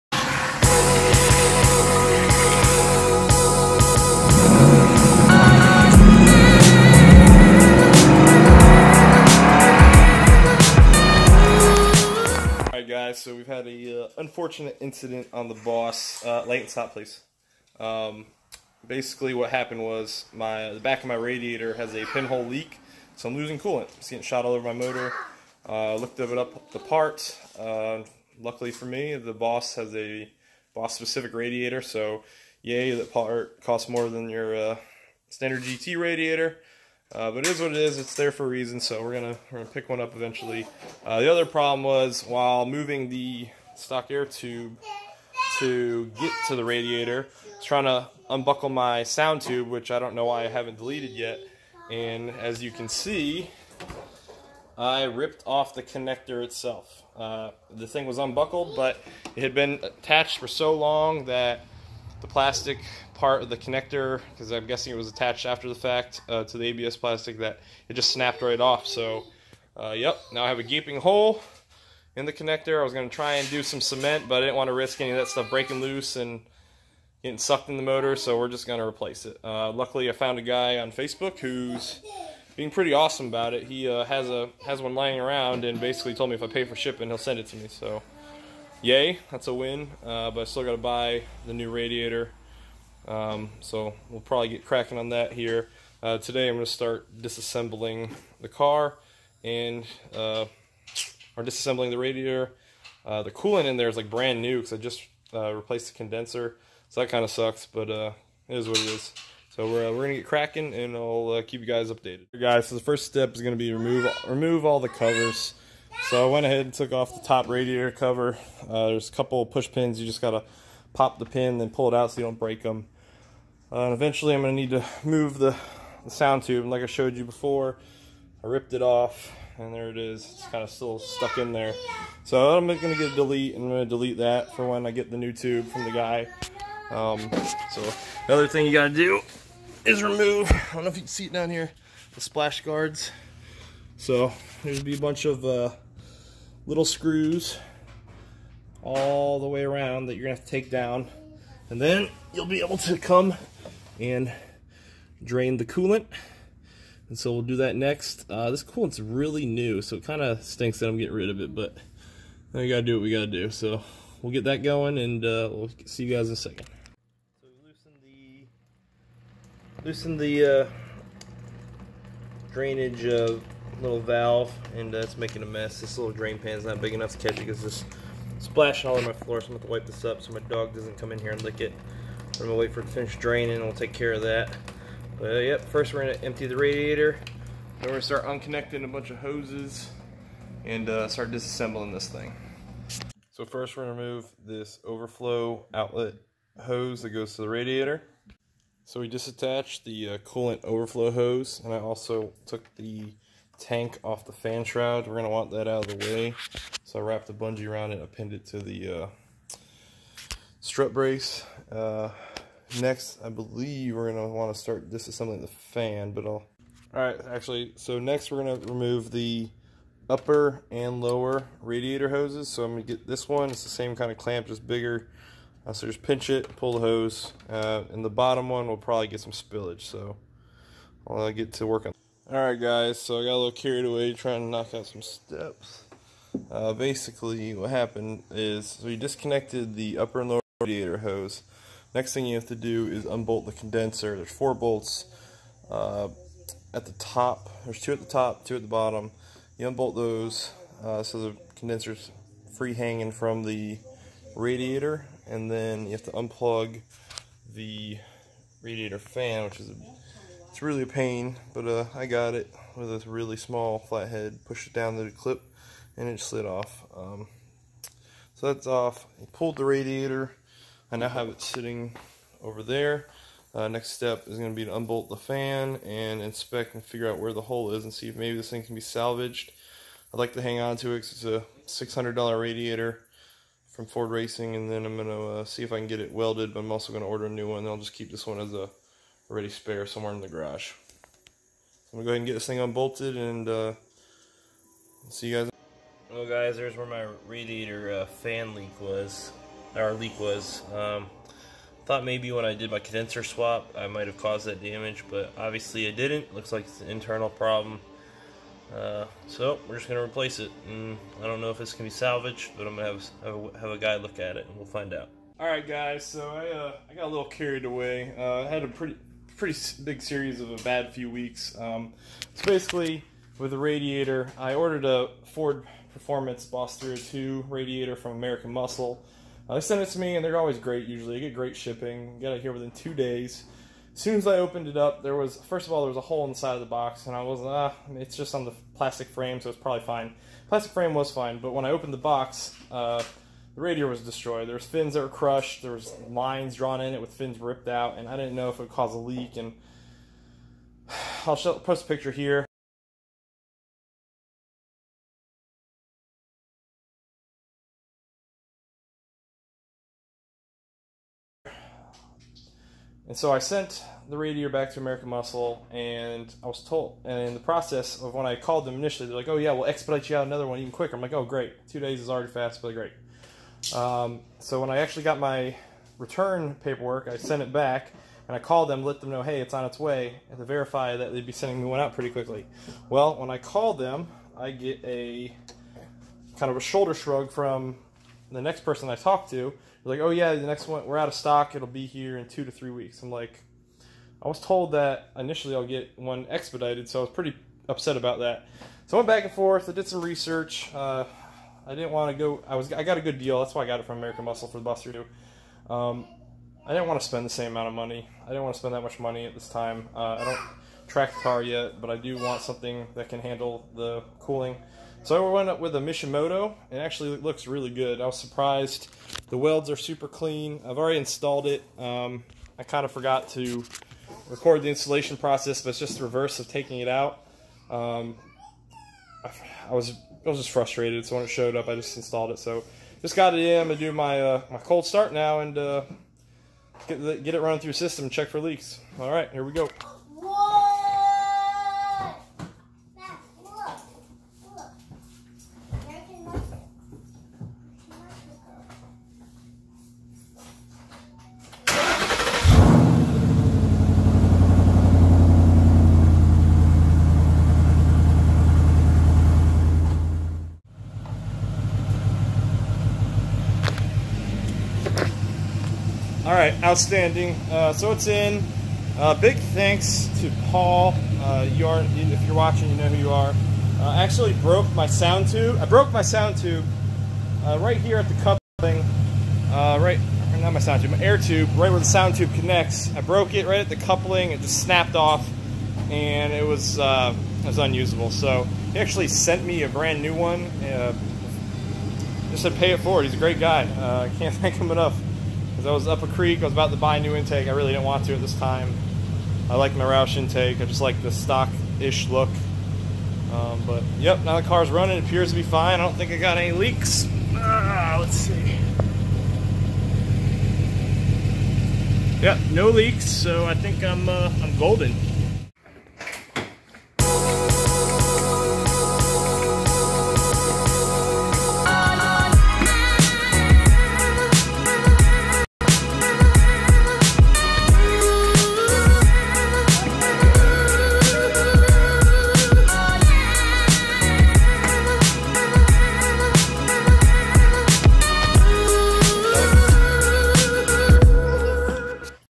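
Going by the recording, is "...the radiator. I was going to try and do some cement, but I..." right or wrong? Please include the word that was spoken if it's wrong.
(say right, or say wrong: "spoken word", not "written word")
wrong: "connector", not "radiator".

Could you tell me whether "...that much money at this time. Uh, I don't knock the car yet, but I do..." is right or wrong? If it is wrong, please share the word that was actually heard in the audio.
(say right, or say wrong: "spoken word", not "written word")
wrong: "track", not "knock".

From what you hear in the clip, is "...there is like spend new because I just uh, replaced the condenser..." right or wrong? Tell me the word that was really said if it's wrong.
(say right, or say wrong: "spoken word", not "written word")
wrong: "brand", not "spend".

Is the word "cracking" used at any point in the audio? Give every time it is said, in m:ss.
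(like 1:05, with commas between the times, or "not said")
1:34, 1:50.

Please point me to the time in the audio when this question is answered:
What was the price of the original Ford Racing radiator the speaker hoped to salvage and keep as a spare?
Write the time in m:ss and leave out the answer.
4:41.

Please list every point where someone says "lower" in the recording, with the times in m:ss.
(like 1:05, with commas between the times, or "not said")
3:41, 4:00.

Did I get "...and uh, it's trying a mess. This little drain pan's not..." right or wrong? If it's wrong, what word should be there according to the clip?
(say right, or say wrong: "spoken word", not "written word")
wrong: "making", not "trying".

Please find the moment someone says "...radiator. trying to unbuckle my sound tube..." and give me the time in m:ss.
0:46.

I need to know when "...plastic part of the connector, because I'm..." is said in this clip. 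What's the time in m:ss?
1:02.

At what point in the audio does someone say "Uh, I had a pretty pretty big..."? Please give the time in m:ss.
5:18.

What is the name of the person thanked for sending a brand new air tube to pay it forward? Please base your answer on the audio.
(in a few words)
Paul.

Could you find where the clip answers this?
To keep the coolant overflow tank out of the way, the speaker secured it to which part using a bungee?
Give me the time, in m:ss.
3:30.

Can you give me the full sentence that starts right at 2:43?
So we'll get that going, and uh, we'll see you guys in a second.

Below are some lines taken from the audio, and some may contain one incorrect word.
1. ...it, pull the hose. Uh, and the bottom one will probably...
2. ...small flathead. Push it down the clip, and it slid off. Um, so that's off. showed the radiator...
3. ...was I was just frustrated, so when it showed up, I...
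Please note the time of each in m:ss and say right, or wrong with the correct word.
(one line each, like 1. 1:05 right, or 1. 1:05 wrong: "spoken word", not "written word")
1. 3:46 right
2. 4:23 wrong: "pulled", not "showed"
3. 7:09 right.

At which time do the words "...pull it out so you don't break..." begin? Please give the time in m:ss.
2:01.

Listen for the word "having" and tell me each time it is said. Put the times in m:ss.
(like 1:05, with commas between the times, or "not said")
not said.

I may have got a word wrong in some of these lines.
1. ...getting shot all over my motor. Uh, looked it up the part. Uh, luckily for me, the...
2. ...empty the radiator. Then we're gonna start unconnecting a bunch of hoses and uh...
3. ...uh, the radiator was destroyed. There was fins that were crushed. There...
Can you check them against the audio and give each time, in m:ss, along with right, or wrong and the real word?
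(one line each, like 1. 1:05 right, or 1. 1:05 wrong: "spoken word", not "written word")
1. 0:24 right
2. 3:06 right
3. 5:42 right.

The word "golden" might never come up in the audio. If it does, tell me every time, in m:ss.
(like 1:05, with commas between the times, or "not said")
8:34.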